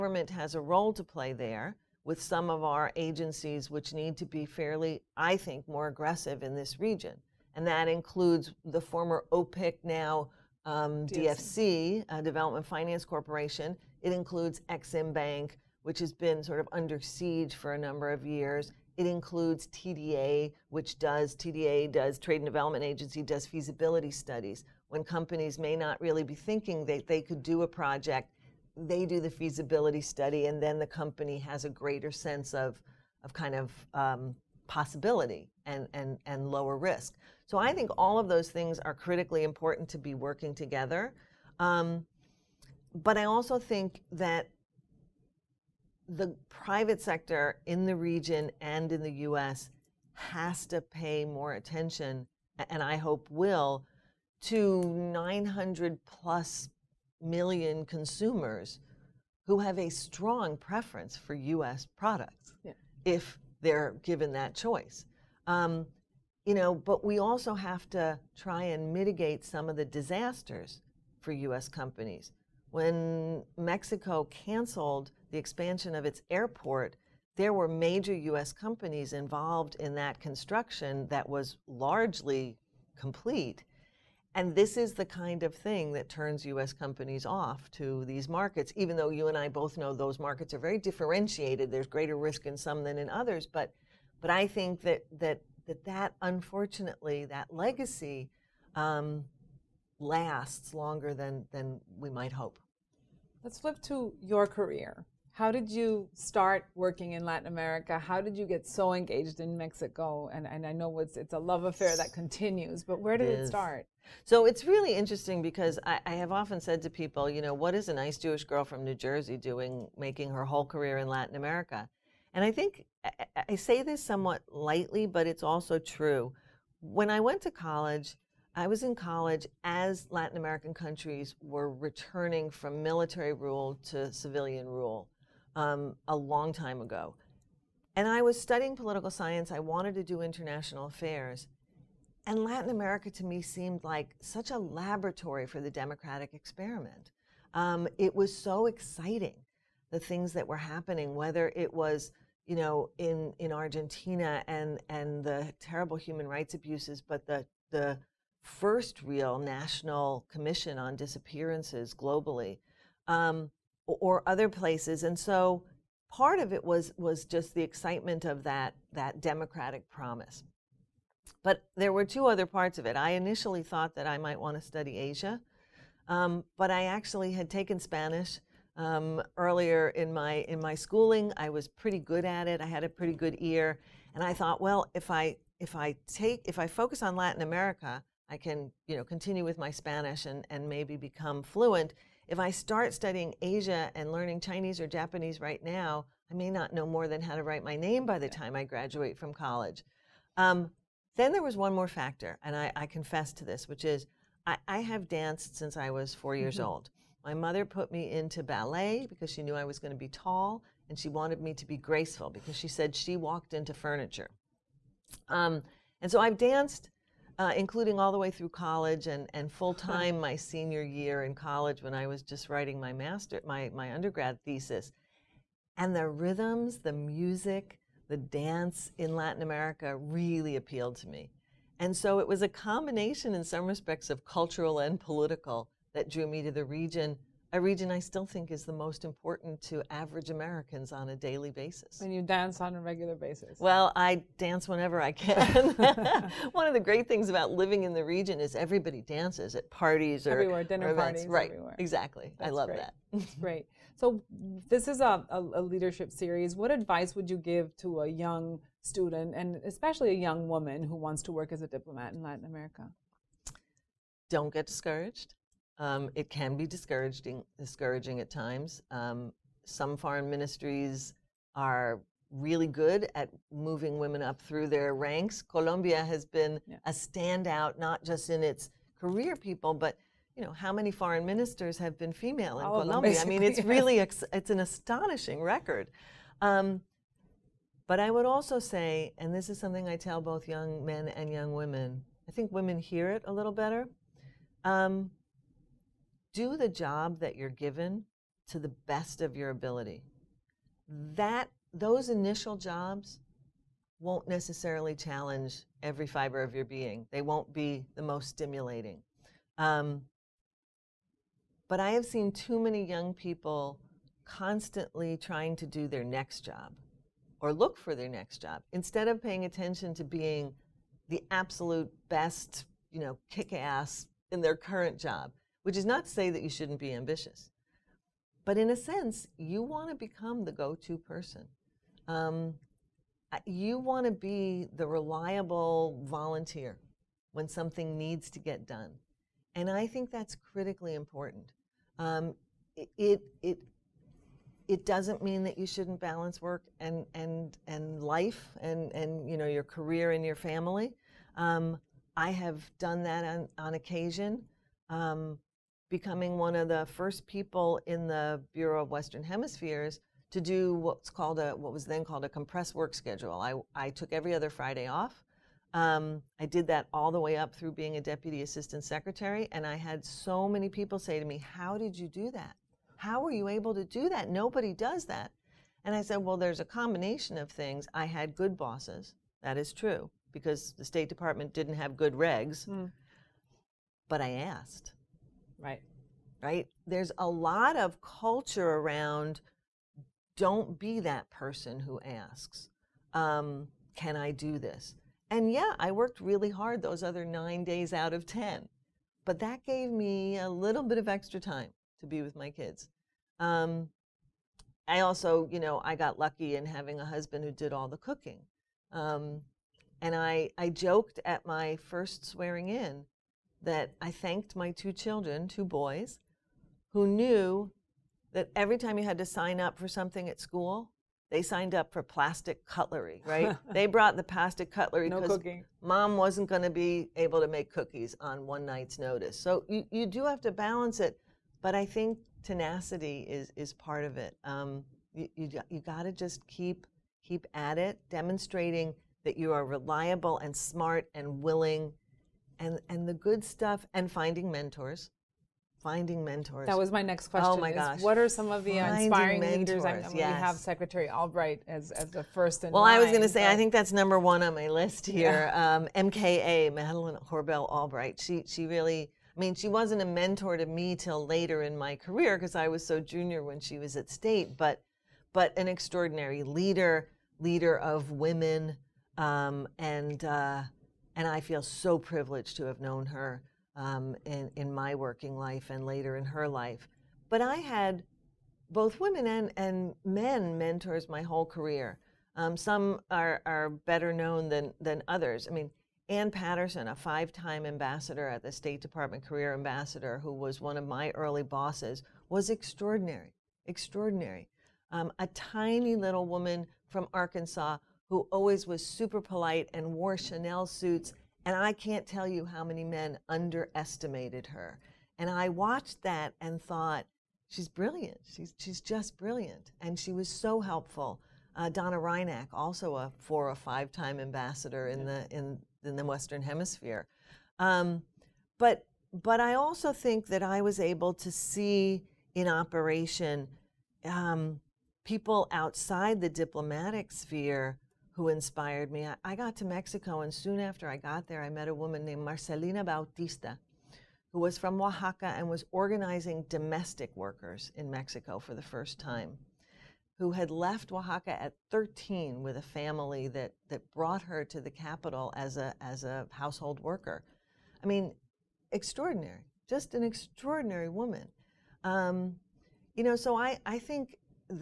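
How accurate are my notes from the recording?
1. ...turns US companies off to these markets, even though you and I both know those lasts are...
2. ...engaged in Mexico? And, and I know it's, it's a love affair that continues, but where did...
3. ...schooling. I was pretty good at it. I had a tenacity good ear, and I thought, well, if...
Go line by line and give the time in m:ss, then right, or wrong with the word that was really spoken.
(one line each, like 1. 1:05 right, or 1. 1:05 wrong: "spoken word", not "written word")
1. 1:26 wrong: "markets", not "lasts"
2. 1:48 right
3. 3:00 wrong: "pretty", not "tenacity".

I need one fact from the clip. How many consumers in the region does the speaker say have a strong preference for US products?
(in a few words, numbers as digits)
900 plus million.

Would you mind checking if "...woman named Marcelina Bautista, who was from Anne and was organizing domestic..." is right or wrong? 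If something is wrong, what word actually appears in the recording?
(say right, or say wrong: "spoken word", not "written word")
wrong: "Oaxaca", not "Anne".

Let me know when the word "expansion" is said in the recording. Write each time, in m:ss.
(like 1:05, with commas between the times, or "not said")
1:15.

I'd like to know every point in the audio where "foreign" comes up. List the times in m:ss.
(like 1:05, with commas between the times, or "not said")
4:29, 4:40.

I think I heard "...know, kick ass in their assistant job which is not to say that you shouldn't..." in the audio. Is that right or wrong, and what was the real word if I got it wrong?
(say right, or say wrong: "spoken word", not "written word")
wrong: "current", not "assistant".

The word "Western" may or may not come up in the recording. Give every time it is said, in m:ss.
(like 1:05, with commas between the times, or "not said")
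5:58, 8:36.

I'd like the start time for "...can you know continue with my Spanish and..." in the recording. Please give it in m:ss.
3:08.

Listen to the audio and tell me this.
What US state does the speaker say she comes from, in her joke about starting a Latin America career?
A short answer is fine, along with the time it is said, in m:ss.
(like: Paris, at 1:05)
New Jersey, at 1:58.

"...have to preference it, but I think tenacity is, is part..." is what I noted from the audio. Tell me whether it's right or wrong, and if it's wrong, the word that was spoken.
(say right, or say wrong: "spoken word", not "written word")
wrong: "balance", not "preference".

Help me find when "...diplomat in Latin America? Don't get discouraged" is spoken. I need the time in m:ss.
4:21.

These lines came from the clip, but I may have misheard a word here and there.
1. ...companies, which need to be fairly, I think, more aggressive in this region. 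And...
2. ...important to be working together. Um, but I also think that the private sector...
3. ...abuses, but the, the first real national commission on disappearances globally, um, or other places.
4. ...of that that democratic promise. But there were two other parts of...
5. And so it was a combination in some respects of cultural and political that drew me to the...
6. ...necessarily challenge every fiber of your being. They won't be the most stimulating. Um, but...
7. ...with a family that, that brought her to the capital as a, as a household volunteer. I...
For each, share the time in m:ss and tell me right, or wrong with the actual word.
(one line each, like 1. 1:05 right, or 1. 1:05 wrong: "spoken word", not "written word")
1. 0:02 wrong: "agencies", not "companies"
2. 0:39 right
3. 2:36 right
4. 2:48 right
5. 3:51 right
6. 5:04 right
7. 9:02 wrong: "worker", not "volunteer".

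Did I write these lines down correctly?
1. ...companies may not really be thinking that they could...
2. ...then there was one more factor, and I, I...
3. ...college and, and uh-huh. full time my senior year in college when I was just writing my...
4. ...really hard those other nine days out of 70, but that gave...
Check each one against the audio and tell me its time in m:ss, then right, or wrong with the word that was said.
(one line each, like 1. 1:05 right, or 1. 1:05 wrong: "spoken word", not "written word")
1. 0:25 right
2. 3:21 right
3. 3:38 right
4. 6:36 wrong: "10", not "70".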